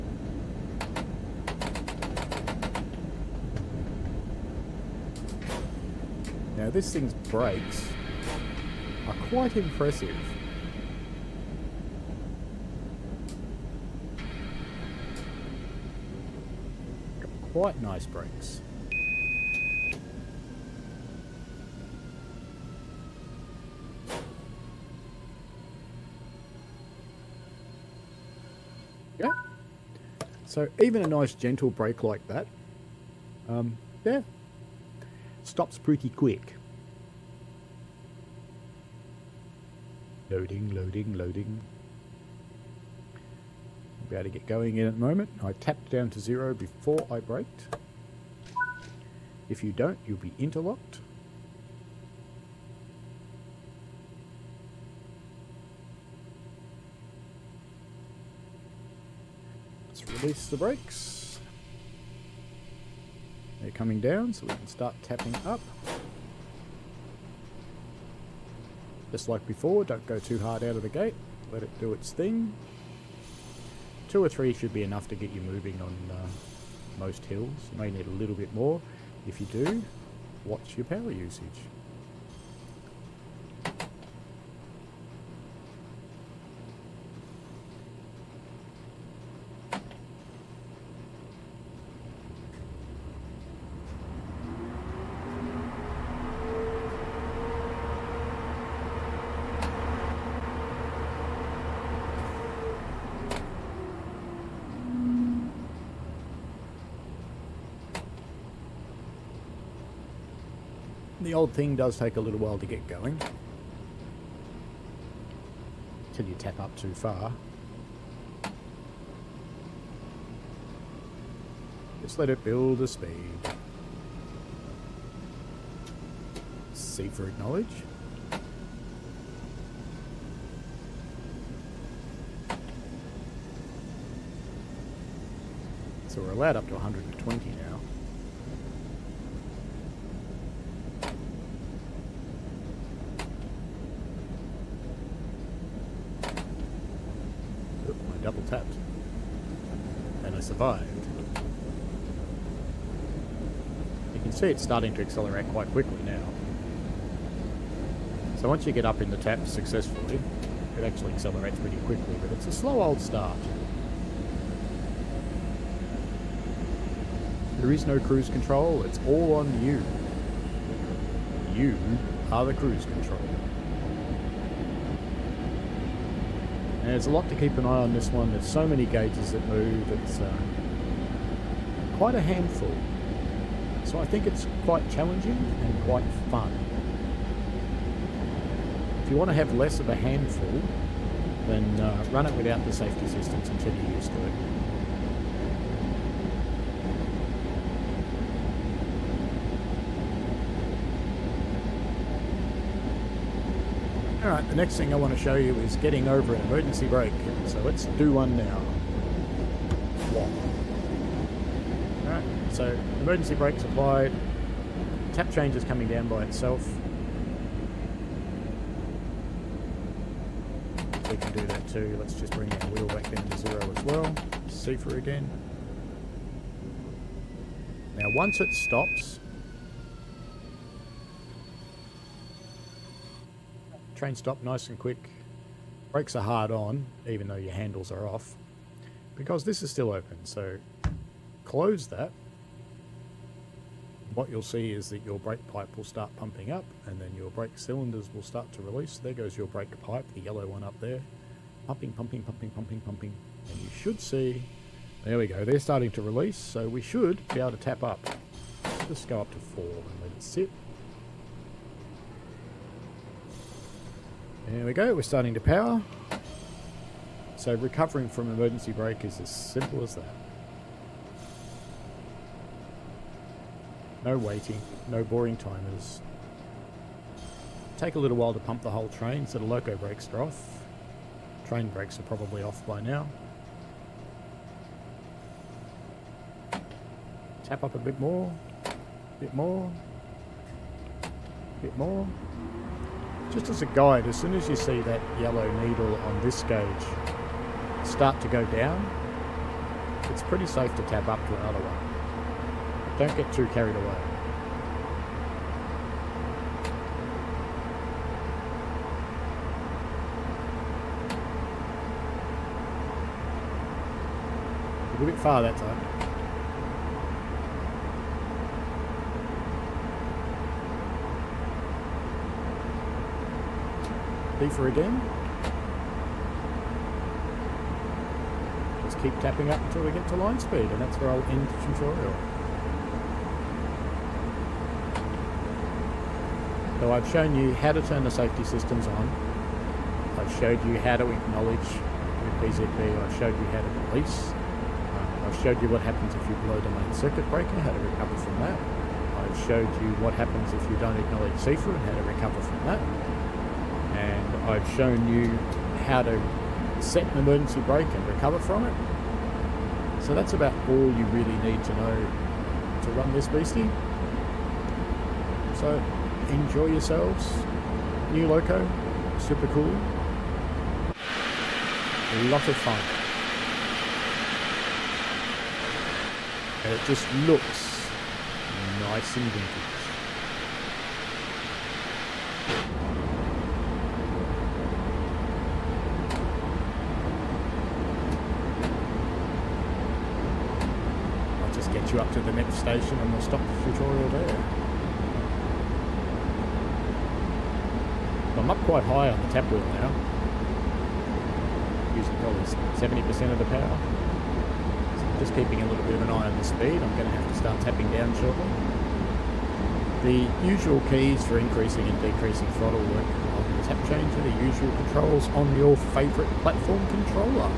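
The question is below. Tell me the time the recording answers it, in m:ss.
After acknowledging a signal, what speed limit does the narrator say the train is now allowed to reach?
2:16.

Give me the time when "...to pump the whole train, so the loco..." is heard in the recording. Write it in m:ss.
4:38.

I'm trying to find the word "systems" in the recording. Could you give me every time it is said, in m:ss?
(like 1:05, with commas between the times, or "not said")
3:13, 5:38.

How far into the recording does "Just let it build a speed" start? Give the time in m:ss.
2:02.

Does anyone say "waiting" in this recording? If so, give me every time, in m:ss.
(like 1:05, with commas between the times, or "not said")
4:34.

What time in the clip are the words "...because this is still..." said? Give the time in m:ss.
3:59.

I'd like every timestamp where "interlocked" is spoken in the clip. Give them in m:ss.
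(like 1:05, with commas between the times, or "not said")
0:50.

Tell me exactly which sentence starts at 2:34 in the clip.
You can see it's starting to accelerate quite quickly now.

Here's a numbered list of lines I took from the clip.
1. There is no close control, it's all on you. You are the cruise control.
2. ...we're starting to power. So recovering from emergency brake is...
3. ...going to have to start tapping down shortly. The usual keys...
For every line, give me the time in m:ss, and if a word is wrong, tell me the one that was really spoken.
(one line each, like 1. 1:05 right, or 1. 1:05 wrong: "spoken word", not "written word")
1. 2:47 wrong: "cruise", not "close"
2. 4:24 right
3. 6:46 right.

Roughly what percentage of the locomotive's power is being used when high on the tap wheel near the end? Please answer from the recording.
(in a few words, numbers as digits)
70%.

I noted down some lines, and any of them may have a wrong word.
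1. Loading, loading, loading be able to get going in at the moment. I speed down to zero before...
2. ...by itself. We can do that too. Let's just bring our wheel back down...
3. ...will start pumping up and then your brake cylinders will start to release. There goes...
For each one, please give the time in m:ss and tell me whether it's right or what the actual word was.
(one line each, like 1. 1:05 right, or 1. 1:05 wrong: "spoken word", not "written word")
1. 0:40 wrong: "tapped", not "speed"
2. 3:36 right
3. 4:05 right.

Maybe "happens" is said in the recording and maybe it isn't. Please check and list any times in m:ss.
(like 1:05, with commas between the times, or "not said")
5:45, 5:50.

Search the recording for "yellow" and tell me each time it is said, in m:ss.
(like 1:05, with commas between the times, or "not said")
4:10, 4:55.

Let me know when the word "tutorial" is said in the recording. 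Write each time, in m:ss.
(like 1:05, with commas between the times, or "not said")
5:31, 6:33.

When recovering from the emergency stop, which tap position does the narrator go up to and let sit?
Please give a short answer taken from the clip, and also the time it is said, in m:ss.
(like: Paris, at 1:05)
4, at 4:19.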